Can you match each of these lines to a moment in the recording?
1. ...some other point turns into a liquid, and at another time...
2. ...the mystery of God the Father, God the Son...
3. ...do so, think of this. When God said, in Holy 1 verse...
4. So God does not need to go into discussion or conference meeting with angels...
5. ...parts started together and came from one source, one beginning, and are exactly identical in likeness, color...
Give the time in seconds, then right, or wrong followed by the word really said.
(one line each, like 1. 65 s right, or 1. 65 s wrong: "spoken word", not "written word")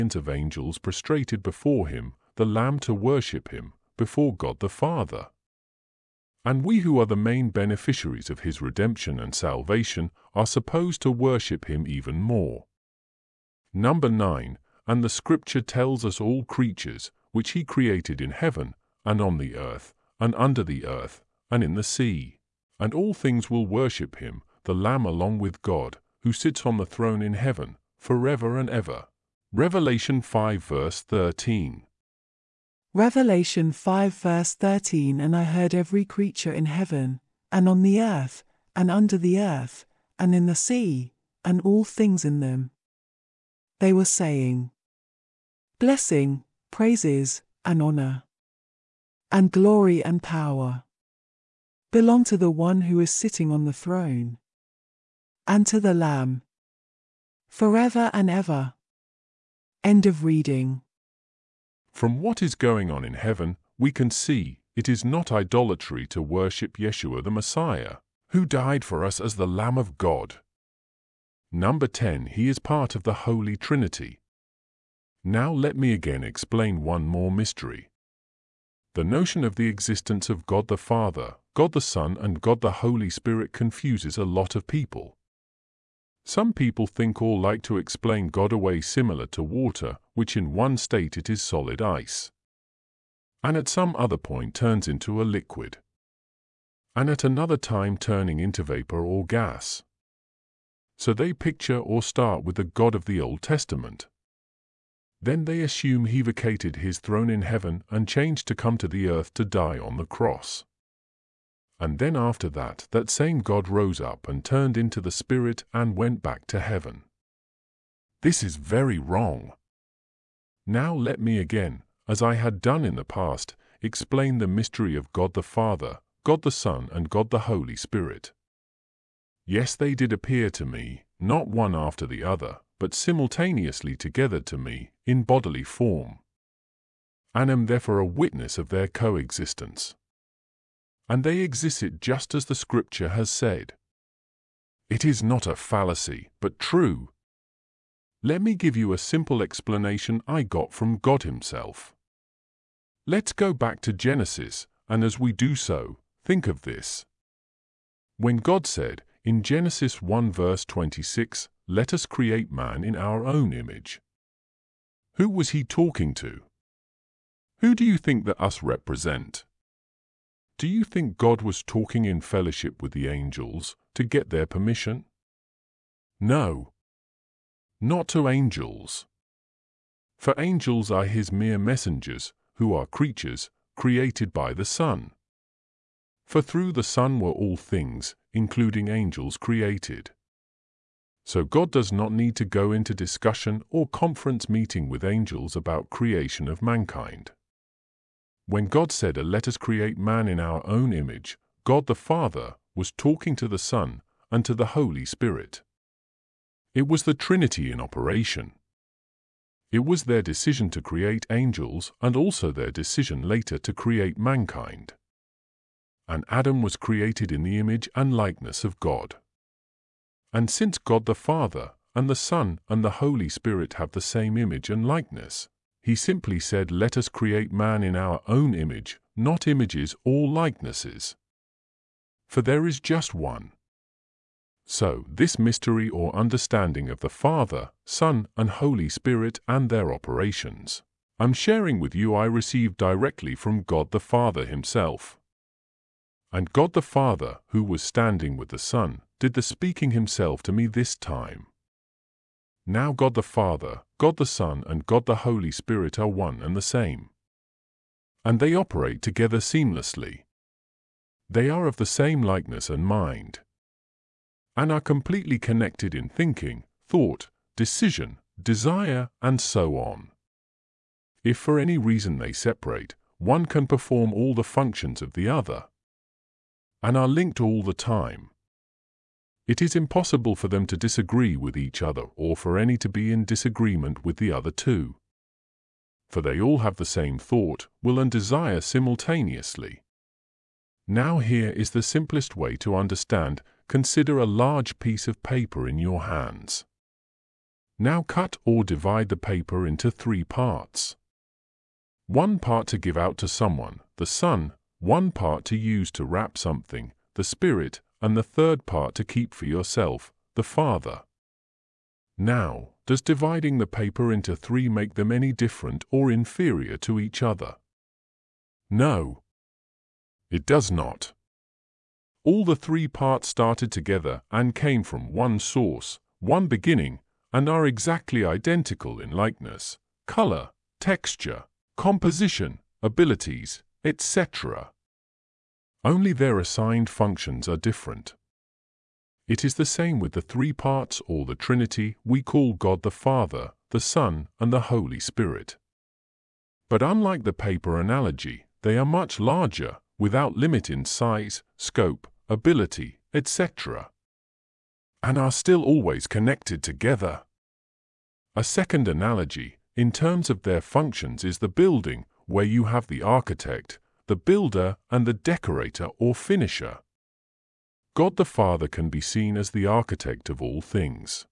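1. 93 s right
2. 124 s right
3. 155 s wrong: "Genesis", not "Holy"
4. 191 s right
5. 322 s right.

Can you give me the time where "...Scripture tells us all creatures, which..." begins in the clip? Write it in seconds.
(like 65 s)
15 s.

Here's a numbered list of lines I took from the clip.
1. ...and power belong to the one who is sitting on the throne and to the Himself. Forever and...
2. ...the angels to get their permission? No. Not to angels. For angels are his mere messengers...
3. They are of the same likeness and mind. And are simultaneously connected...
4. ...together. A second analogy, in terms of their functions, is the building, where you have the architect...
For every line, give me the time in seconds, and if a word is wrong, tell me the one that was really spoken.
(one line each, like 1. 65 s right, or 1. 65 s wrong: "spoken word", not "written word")
1. 50 s wrong: "Lamb", not "Himself"
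2. 172 s right
3. 261 s wrong: "completely", not "simultaneously"
4. 356 s right.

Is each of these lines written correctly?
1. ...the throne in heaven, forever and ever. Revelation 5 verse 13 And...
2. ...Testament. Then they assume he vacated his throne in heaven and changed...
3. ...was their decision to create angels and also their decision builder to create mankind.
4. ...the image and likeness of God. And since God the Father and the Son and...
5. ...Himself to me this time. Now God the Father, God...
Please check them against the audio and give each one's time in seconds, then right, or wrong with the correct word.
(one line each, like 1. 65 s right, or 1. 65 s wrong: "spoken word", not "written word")
1. 26 s wrong: "Revelation", not "And"
2. 103 s right
3. 209 s wrong: "later", not "builder"
4. 217 s right
5. 249 s right.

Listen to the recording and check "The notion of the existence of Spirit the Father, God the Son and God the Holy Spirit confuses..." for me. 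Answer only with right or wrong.
wrong.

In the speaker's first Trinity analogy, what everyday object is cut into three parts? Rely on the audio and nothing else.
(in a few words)
A large piece of paper.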